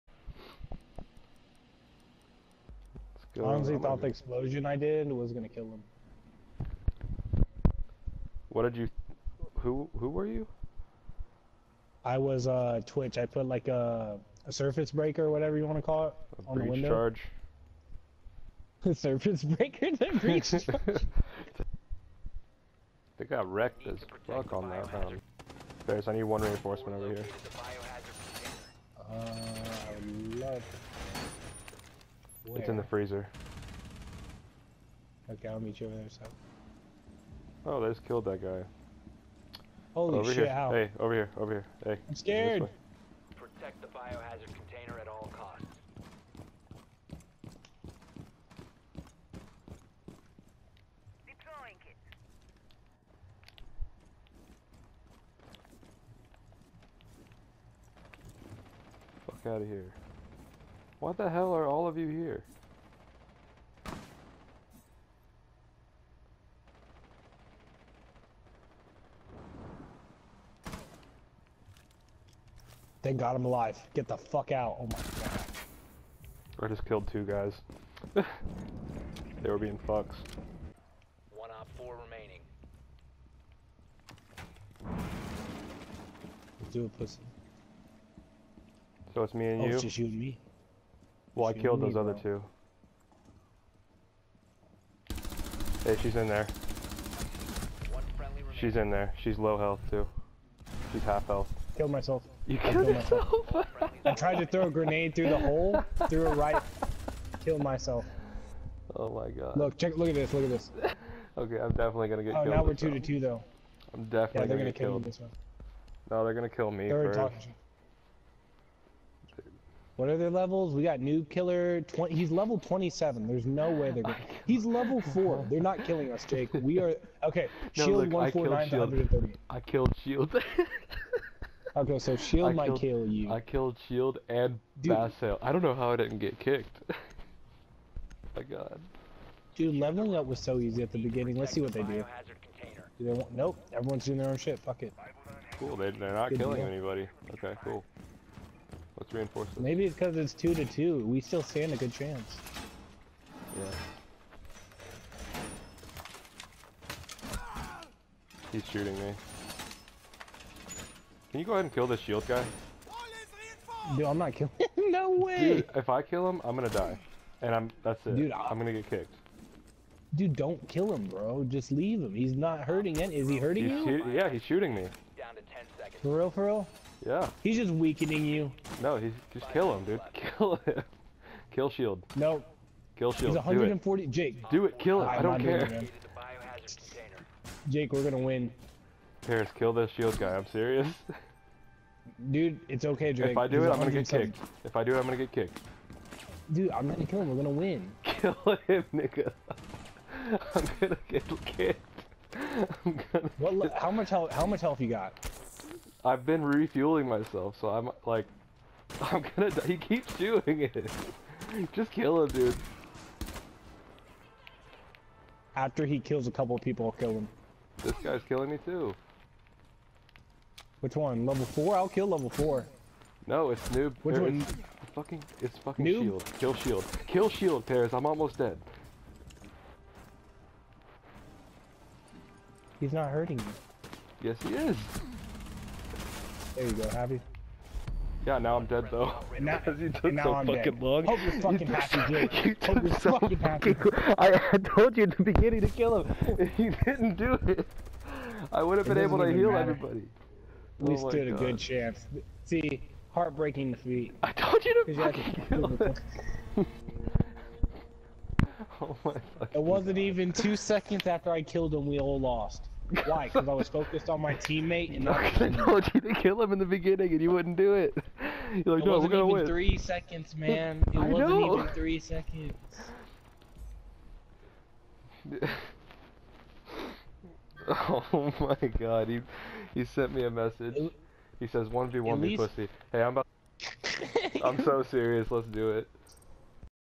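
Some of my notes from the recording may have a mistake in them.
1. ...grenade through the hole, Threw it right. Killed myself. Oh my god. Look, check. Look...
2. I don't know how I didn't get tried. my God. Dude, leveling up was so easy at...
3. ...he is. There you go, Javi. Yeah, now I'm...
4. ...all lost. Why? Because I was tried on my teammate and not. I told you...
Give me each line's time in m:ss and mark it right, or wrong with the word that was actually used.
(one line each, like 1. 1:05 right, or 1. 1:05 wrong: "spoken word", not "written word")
1. 1:44 right
2. 2:15 wrong: "kicked", not "tried"
3. 3:54 right
4. 4:21 wrong: "focused", not "tried".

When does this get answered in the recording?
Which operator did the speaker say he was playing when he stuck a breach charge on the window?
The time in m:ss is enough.
0:12.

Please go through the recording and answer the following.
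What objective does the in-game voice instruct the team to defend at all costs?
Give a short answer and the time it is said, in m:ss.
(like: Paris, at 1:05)
Biohazard container, at 0:43.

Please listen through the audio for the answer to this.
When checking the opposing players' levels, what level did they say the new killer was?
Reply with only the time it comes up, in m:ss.
2:02.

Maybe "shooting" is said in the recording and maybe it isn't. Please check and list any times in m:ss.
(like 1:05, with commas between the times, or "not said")
2:38, 2:54.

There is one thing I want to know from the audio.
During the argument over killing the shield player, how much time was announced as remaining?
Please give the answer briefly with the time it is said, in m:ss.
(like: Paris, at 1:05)
10 seconds, at 2:55.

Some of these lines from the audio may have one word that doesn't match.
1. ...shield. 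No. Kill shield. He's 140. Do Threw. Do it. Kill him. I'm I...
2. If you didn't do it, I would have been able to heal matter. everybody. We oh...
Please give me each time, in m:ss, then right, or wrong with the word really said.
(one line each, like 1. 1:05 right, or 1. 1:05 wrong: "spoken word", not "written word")
1. 3:01 wrong: "Jake", not "Threw"
2. 4:06 right.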